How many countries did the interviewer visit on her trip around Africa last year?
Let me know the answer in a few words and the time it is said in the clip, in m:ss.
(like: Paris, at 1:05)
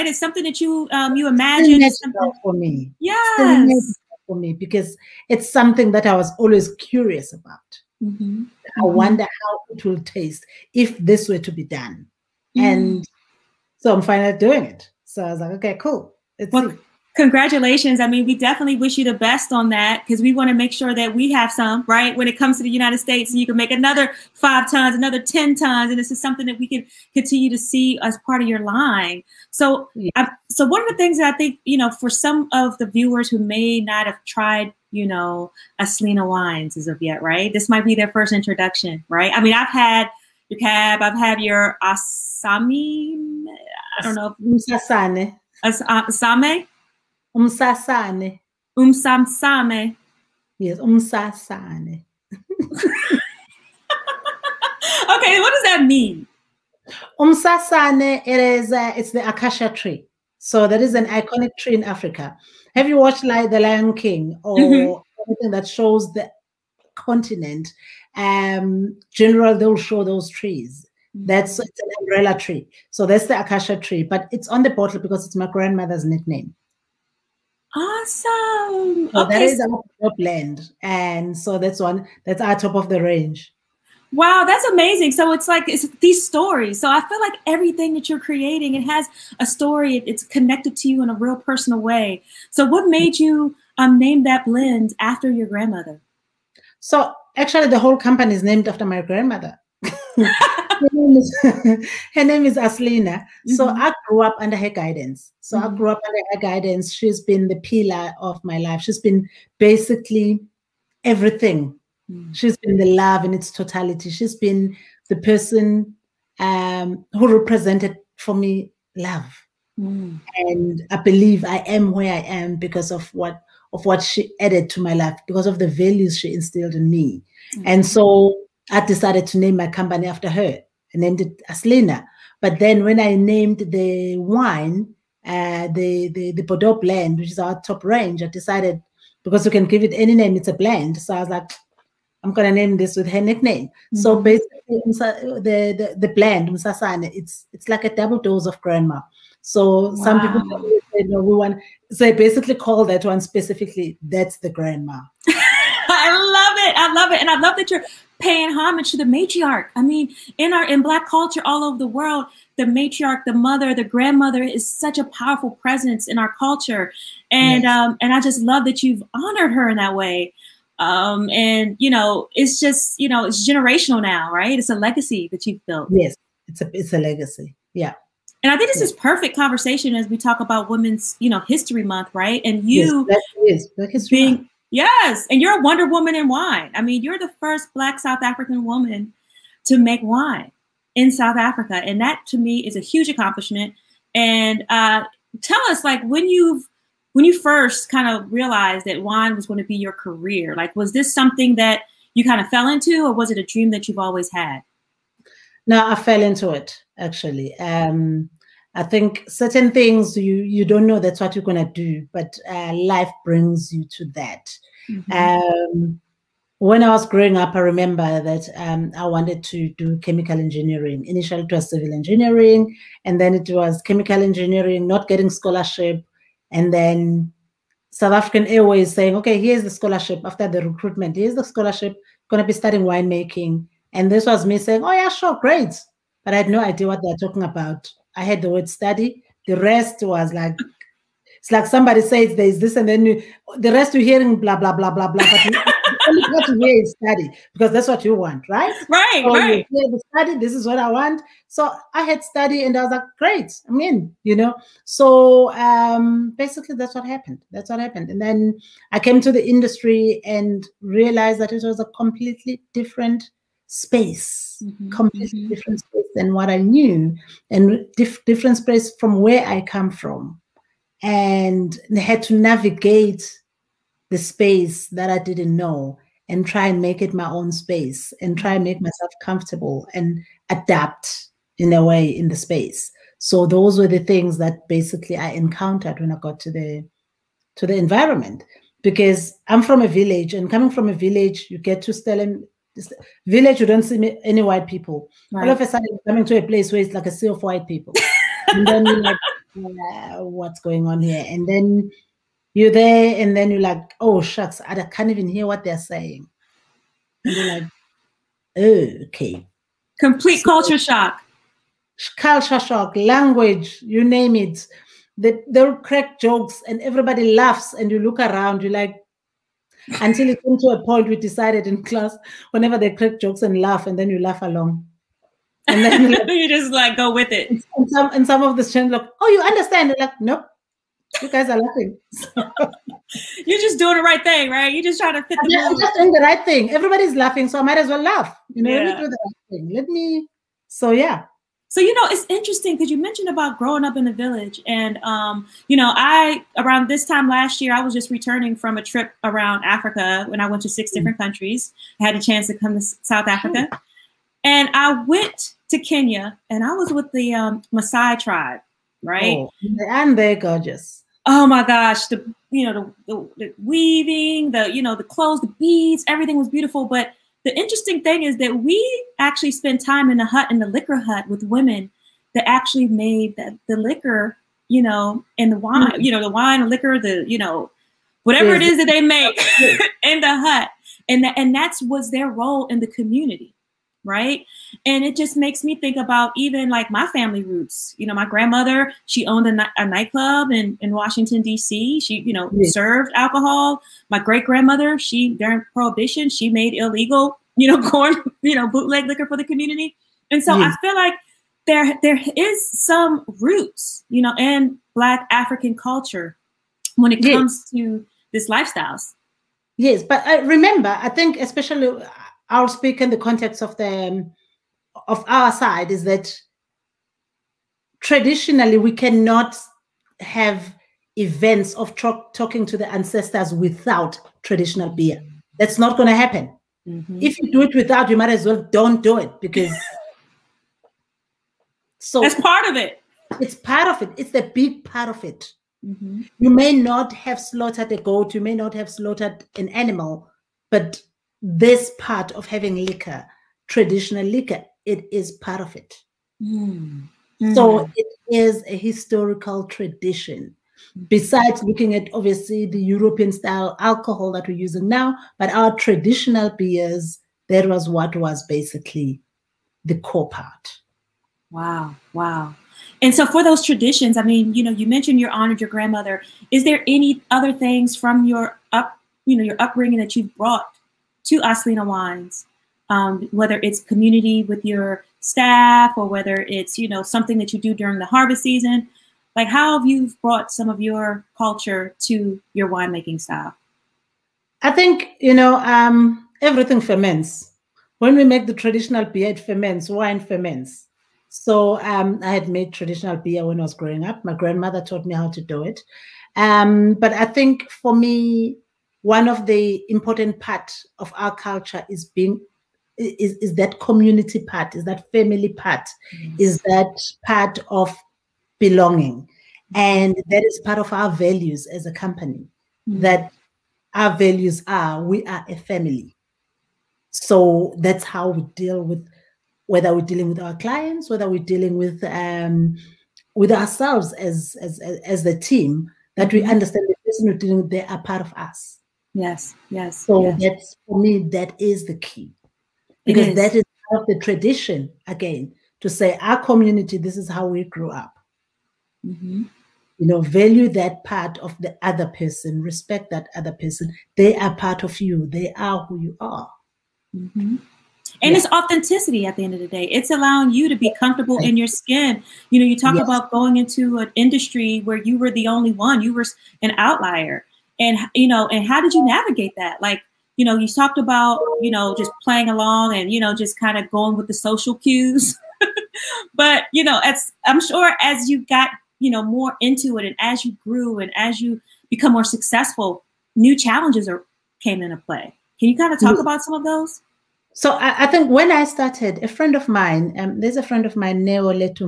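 6, at 5:50.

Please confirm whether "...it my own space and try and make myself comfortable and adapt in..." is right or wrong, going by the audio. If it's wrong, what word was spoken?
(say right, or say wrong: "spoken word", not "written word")
right.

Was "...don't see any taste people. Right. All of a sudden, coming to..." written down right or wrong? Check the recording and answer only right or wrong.
wrong.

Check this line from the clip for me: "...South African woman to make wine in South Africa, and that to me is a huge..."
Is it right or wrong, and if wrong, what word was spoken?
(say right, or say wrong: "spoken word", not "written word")
right.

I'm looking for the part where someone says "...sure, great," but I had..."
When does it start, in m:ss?
3:55.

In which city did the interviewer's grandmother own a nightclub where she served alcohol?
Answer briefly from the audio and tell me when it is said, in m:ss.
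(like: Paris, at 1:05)
Washington, D.C., at 6:30.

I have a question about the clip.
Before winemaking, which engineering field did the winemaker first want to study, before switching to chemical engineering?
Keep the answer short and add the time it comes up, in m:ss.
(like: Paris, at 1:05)
Civil engineering, at 3:41.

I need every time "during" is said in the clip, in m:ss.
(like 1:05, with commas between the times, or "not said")
6:35, 7:57.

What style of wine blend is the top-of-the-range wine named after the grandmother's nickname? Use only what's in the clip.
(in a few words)
Bordeaux blend.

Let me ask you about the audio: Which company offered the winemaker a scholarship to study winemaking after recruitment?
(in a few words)
South African Airways.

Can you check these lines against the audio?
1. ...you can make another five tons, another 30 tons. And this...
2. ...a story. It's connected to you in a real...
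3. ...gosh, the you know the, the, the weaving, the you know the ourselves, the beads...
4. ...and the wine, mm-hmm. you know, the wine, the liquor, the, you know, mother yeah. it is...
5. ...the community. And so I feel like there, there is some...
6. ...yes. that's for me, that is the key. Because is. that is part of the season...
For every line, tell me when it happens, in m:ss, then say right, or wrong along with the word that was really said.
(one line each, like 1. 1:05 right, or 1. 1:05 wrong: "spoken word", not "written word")
1. 0:23 wrong: "10", not "30"
2. 1:29 right
3. 6:01 wrong: "clothes", not "ourselves"
4. 6:15 wrong: "whatever", not "mother"
5. 6:39 right
6. 8:50 wrong: "tradition", not "season".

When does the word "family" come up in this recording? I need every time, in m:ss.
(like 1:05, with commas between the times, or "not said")
6:27, 8:25, 8:35.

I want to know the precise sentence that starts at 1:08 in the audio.
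Um, general, they'll show those trees.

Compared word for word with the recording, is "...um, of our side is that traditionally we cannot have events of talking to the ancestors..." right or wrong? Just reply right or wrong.
right.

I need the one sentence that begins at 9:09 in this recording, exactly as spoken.
It's allowing you to be comfortable in your skin.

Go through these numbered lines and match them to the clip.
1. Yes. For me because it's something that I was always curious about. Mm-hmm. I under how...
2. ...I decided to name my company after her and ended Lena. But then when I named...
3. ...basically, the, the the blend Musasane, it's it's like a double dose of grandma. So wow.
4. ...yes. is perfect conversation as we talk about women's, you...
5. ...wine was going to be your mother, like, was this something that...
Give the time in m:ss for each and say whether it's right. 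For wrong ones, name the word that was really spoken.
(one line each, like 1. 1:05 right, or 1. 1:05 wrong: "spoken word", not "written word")
1. 0:03 wrong: "wonder", not "under"
2. 2:08 right
3. 2:24 right
4. 2:58 right
5. 3:19 wrong: "career", not "mother".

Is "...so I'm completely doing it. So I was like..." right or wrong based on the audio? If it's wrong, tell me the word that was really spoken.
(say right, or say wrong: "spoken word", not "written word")
wrong: "finally", not "completely".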